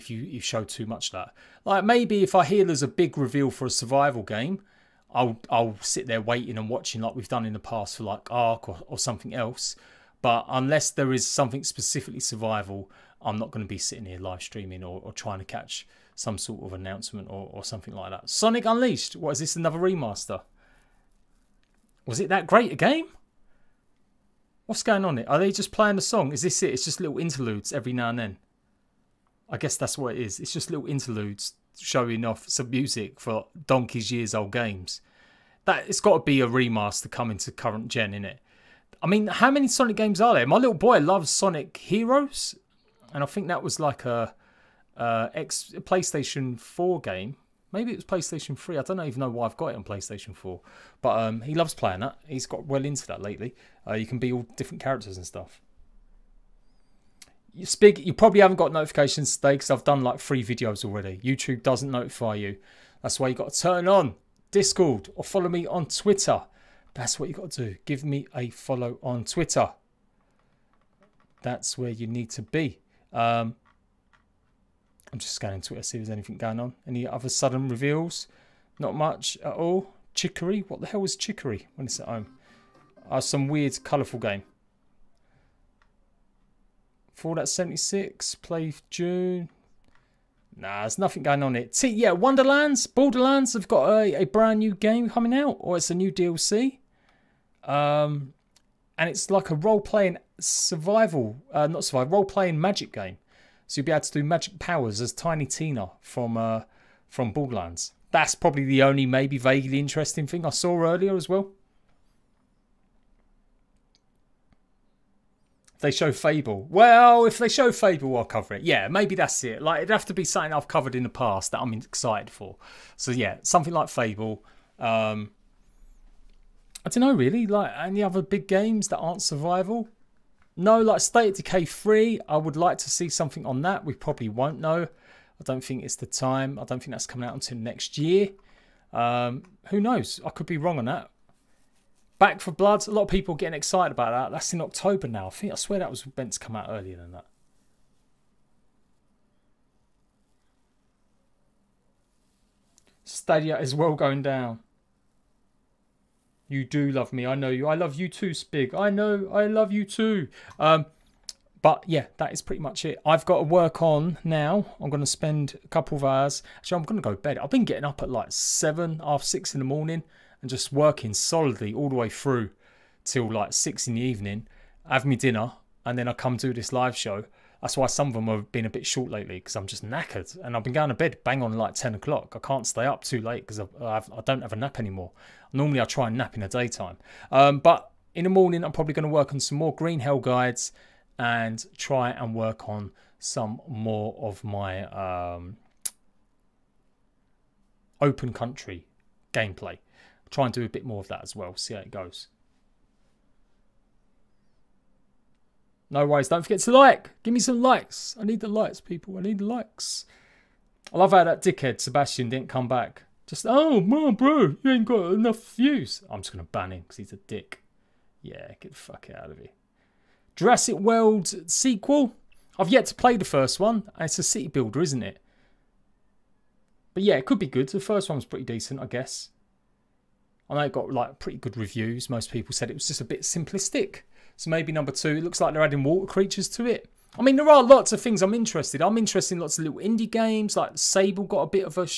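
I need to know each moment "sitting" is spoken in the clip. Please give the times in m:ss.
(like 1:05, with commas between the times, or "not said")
0:13.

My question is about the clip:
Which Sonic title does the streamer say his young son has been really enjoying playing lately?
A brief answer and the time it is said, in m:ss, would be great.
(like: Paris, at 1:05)
Sonic Heroes, at 0:41.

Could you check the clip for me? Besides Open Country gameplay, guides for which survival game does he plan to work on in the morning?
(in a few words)
Green Hell.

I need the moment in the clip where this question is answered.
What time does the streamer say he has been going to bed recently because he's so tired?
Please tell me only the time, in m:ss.
3:01.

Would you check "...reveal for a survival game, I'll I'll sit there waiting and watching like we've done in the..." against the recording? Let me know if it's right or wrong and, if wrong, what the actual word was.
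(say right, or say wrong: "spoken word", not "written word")
right.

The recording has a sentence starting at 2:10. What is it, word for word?
No, like State Decay 3, I would like to see something on that.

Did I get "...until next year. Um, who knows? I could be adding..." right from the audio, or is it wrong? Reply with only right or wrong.
wrong.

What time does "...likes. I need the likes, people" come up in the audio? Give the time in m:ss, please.
3:27.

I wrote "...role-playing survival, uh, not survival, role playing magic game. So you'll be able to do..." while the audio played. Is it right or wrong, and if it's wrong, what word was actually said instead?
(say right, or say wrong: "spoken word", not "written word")
right.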